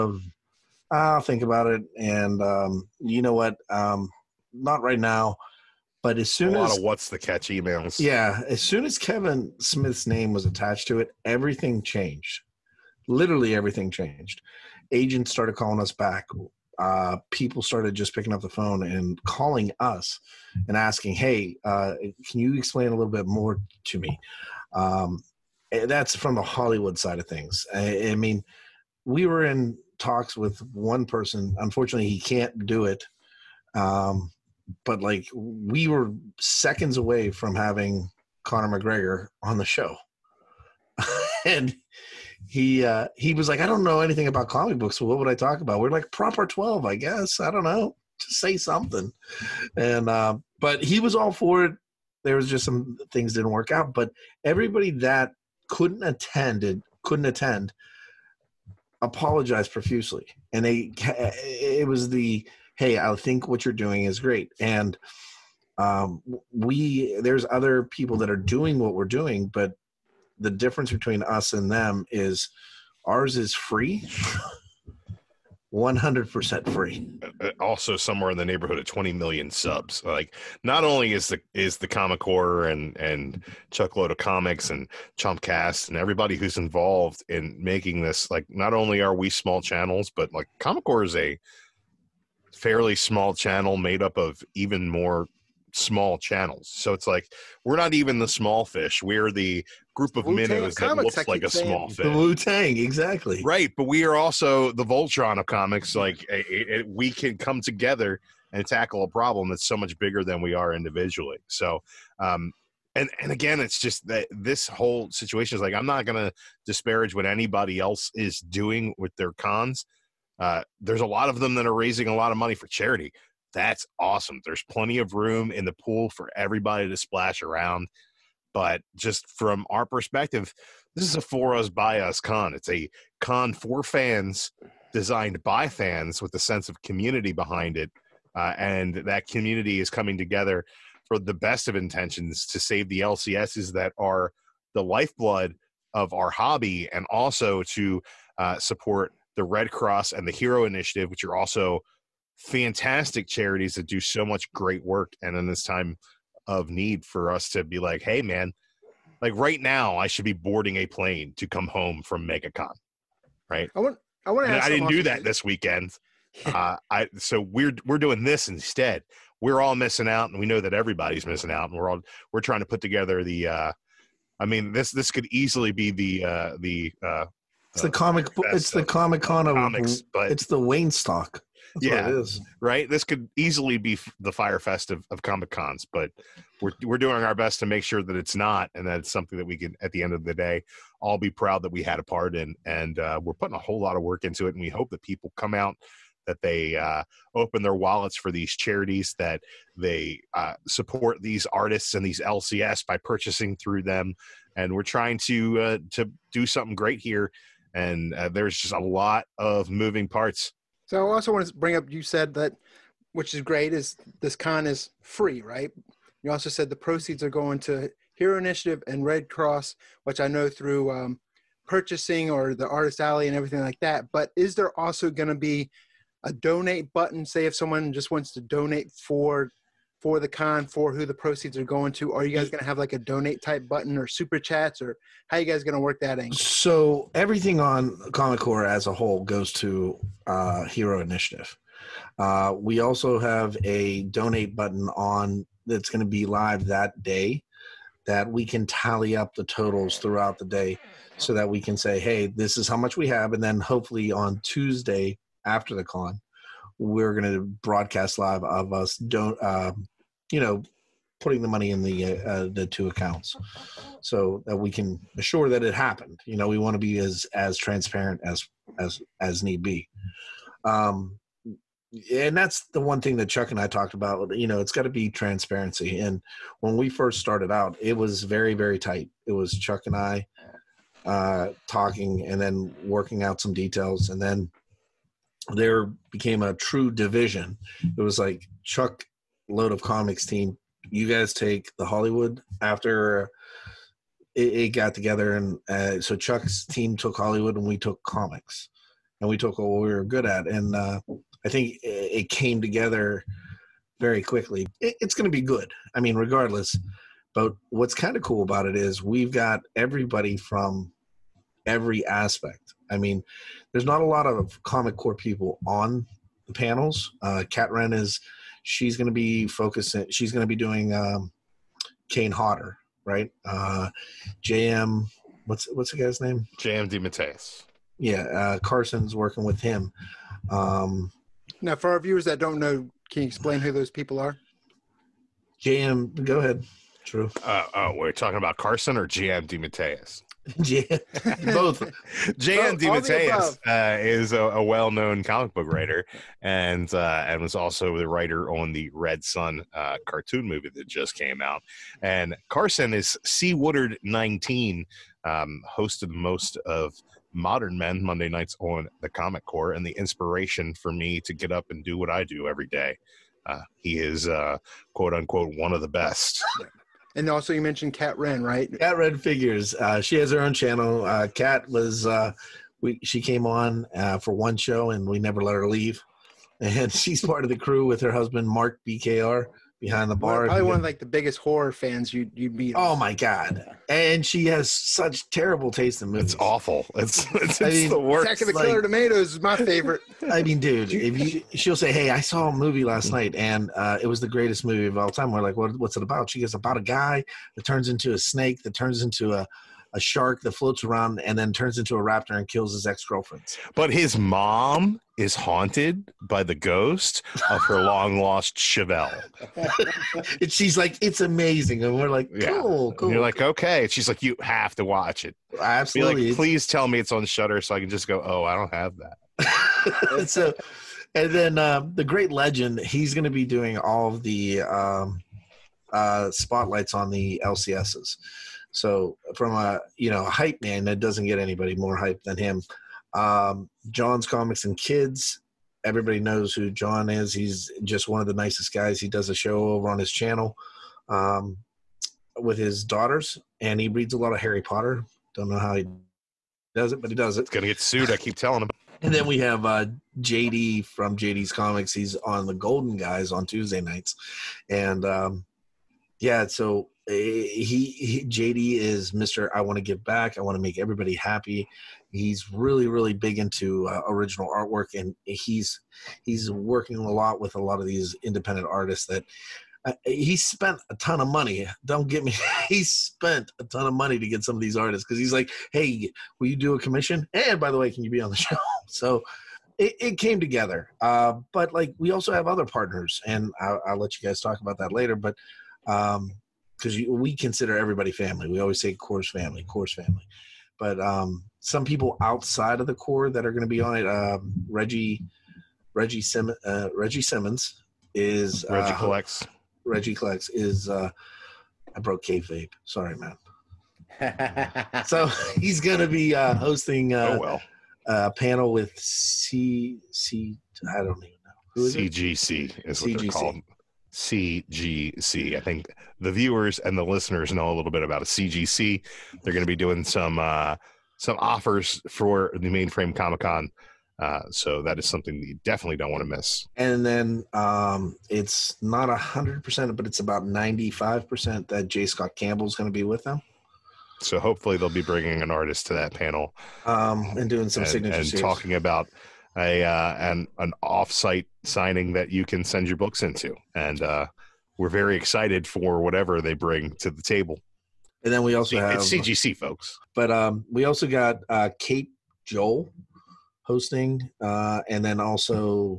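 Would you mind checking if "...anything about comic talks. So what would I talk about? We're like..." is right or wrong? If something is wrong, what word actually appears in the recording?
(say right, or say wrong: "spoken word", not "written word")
wrong: "books", not "talks".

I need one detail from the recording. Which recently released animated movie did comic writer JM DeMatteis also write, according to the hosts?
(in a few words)
Red Sun.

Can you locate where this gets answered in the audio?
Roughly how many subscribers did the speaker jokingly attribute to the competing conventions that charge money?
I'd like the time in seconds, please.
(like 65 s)
78 s.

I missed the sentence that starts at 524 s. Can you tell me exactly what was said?
Uh, so that is something that you definitely don't want to miss.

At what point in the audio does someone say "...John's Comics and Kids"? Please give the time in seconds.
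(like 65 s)
433 s.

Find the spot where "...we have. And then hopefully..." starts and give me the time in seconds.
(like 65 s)
252 s.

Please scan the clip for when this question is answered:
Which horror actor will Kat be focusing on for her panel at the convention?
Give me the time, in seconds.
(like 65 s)
322 s.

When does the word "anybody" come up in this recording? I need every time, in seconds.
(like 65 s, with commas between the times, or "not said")
117 s, 431 s.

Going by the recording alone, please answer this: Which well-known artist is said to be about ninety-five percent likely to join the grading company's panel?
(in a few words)
J. Scott Campbell.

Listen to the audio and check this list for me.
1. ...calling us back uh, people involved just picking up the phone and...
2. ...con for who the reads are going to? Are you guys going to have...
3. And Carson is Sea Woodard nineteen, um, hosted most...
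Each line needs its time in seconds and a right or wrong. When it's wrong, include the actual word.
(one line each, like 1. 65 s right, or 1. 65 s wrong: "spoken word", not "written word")
1. 15 s wrong: "started", not "involved"
2. 230 s wrong: "proceeds", not "reads"
3. 352 s right.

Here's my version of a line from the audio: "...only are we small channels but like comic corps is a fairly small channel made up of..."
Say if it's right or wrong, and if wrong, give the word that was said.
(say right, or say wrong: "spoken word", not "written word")
right.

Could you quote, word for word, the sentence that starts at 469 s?
Uh, he spent a ton of money.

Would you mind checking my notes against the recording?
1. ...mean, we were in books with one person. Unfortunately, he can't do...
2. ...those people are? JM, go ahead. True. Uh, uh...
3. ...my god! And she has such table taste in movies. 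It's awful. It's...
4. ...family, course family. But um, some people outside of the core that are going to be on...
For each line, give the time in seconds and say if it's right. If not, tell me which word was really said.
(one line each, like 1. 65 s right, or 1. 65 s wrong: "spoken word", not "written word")
1. 28 s wrong: "talks", not "books"
2. 333 s right
3. 382 s wrong: "terrible", not "table"
4. 489 s right.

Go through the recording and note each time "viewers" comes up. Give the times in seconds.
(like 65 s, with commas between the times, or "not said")
331 s, 516 s.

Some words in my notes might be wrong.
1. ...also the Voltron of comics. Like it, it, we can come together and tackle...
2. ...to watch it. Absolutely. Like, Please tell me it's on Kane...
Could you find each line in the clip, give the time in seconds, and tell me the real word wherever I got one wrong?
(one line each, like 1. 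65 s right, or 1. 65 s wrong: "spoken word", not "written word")
1. 104 s right
2. 414 s wrong: "Shudder", not "Kane".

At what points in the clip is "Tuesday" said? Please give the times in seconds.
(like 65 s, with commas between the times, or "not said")
254 s, 453 s.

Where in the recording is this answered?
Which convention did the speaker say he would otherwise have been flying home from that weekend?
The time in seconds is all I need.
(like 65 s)
162 s.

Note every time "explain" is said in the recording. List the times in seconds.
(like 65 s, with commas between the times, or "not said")
22 s, 333 s.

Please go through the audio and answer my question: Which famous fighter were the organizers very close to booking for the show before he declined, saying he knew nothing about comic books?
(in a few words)
Conor McGregor.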